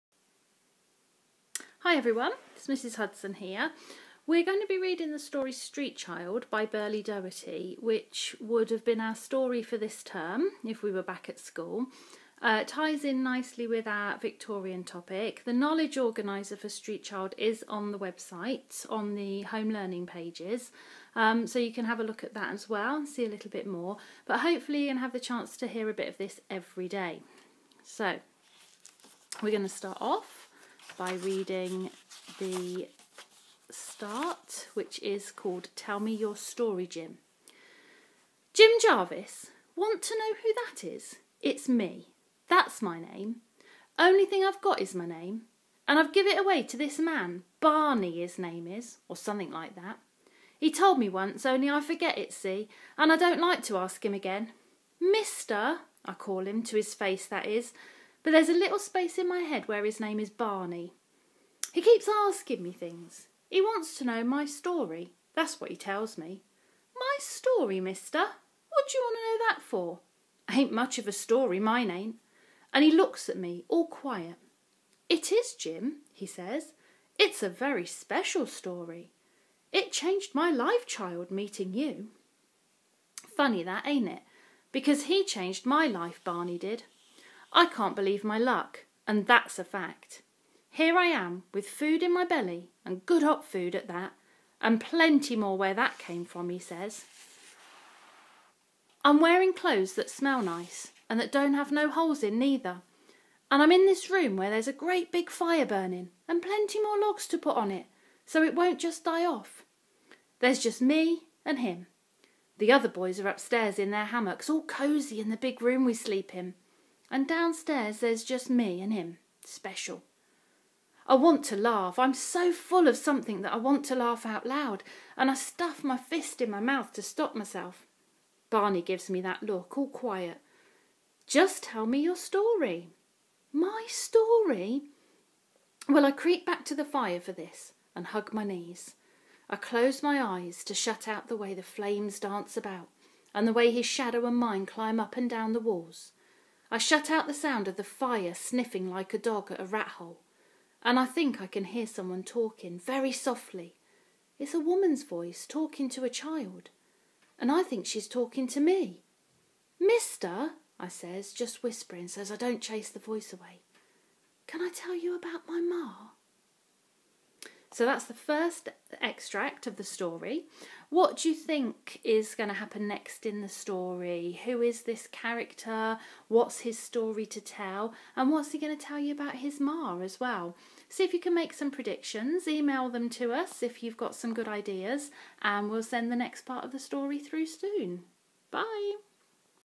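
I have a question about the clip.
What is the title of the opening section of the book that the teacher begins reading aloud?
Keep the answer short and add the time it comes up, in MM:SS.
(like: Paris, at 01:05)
Tell Me Your Story, Jim, at 00:35.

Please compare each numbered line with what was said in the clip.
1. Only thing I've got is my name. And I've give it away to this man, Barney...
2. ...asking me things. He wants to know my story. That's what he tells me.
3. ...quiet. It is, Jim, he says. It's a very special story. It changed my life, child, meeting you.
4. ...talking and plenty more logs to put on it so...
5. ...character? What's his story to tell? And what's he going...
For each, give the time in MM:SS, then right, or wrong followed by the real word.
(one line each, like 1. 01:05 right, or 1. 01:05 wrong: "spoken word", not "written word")
1. 00:43 right
2. 01:02 right
3. 01:13 right
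4. 01:45 wrong: "burning", not "talking"
5. 02:55 right.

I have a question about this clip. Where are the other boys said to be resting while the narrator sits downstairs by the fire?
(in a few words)
In their hammocks.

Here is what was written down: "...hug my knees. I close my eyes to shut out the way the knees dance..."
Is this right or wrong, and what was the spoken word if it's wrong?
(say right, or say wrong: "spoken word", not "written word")
wrong: "flames", not "knees".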